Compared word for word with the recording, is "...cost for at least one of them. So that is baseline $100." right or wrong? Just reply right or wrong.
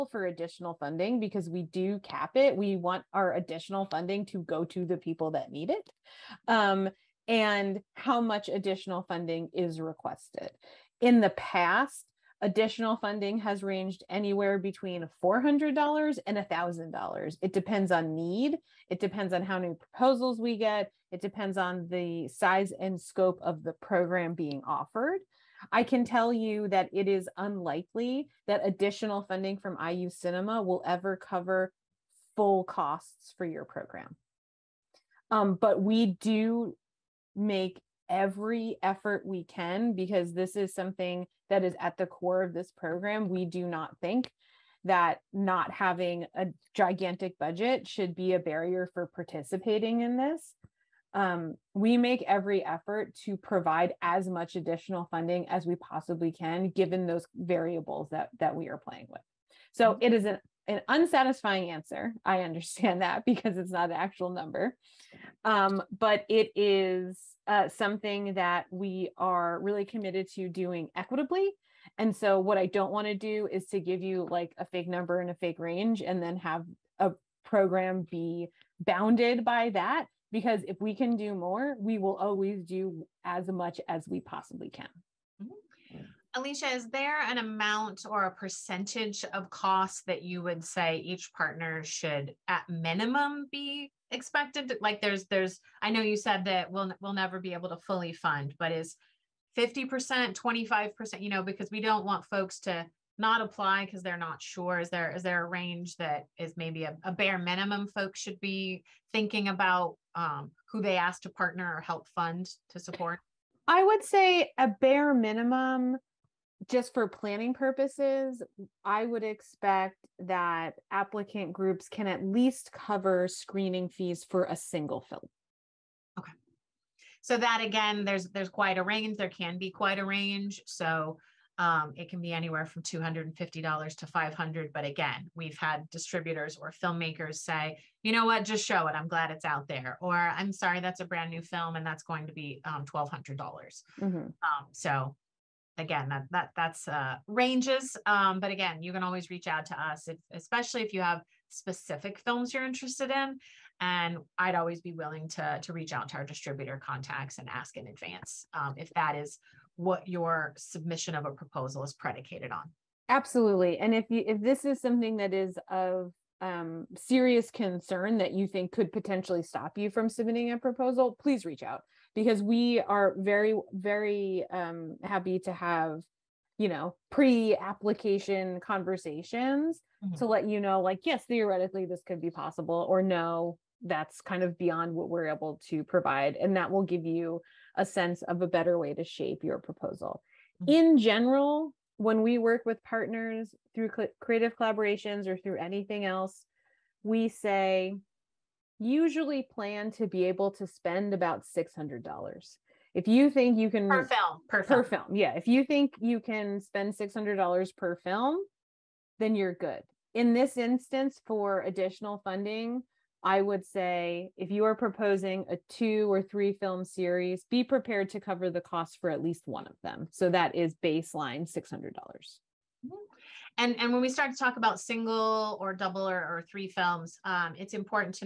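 wrong.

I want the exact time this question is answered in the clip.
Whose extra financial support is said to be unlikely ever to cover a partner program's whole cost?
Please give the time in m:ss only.
0:29.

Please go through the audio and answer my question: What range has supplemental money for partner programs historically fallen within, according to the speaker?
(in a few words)
$400 to $1,000.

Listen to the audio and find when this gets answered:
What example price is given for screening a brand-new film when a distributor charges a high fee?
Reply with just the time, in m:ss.
2:22.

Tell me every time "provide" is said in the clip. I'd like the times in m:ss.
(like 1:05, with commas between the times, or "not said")
0:53, 3:05.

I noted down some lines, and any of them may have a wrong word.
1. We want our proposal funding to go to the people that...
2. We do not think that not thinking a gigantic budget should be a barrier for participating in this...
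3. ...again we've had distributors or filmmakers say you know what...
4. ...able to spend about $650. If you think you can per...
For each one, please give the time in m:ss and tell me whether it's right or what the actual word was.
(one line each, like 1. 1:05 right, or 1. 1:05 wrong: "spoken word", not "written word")
1. 0:02 wrong: "additional", not "proposal"
2. 0:43 wrong: "having", not "thinking"
3. 2:14 right
4. 3:20 wrong: "600", not "650".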